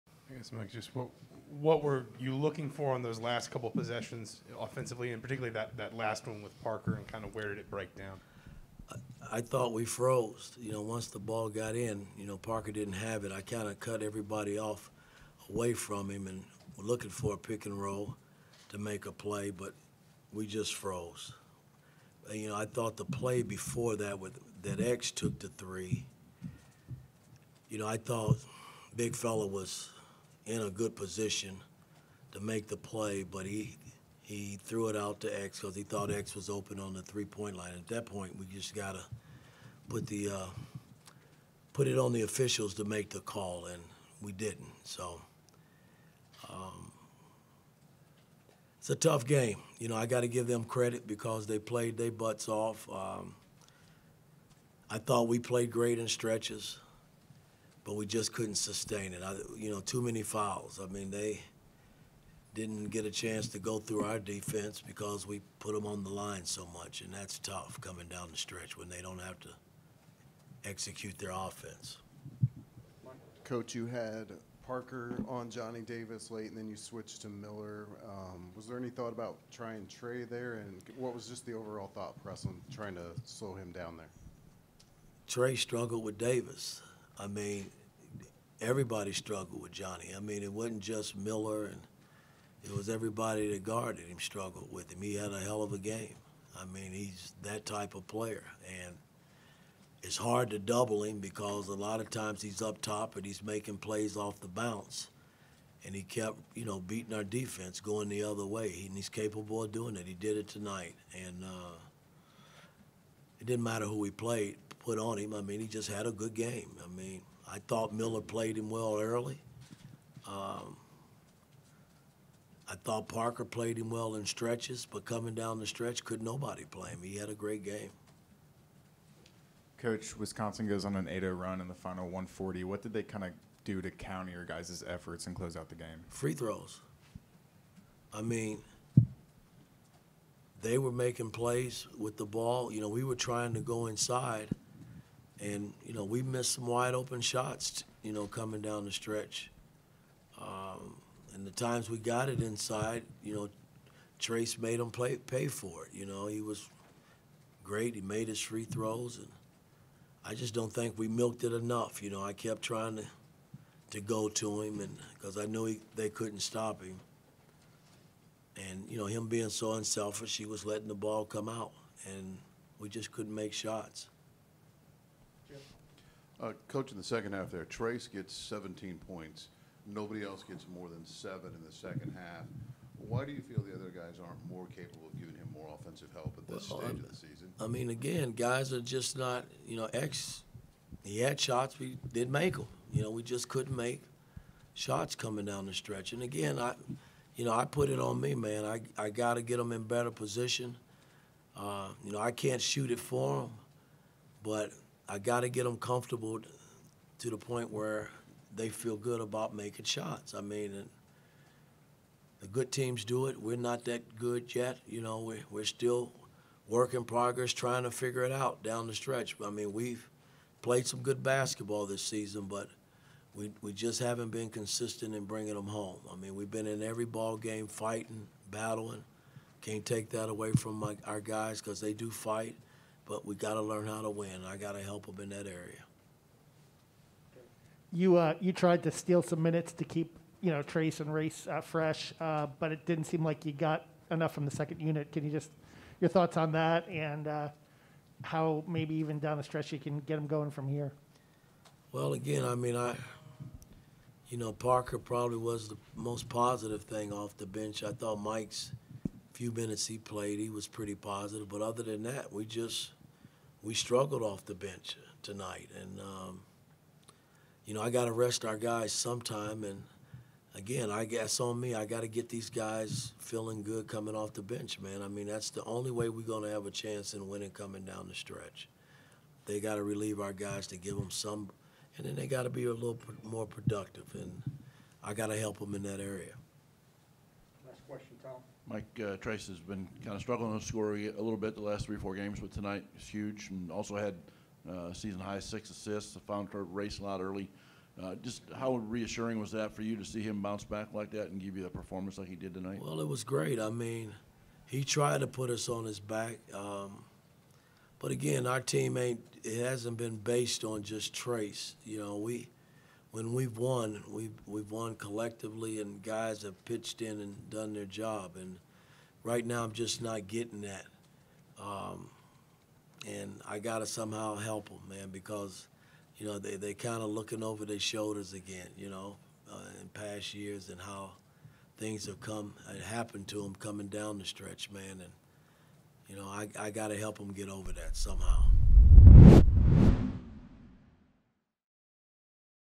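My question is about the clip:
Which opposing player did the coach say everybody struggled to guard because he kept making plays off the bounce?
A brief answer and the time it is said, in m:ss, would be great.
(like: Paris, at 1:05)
Johnny Davis, at 1:15.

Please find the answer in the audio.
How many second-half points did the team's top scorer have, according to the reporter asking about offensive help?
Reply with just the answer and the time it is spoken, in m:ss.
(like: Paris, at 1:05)
17, at 2:58.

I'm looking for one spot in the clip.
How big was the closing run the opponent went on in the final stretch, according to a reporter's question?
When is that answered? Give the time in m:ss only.
2:11.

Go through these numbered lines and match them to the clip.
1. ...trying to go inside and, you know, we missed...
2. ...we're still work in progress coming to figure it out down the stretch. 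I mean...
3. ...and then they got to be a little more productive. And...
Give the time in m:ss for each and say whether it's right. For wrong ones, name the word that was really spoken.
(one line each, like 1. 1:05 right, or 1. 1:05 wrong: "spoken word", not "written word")
1. 2:23 right
2. 3:35 wrong: "trying", not "coming"
3. 4:41 right.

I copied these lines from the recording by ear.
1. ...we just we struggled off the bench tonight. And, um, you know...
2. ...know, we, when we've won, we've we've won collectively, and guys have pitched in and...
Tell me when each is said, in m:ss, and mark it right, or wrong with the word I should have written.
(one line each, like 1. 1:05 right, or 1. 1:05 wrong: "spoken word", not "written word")
1. 4:22 right
2. 5:11 right.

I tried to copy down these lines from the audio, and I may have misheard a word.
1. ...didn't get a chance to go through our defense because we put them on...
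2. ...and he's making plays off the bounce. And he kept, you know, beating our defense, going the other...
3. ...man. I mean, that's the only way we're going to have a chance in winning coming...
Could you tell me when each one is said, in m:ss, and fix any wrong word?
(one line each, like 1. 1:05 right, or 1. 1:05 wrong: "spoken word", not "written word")
1. 1:02 right
2. 1:43 right
3. 4:34 right.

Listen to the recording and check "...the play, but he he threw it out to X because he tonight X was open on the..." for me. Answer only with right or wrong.
wrong.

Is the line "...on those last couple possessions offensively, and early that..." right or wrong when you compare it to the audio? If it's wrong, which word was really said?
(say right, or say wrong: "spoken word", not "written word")
wrong: "particularly", not "early".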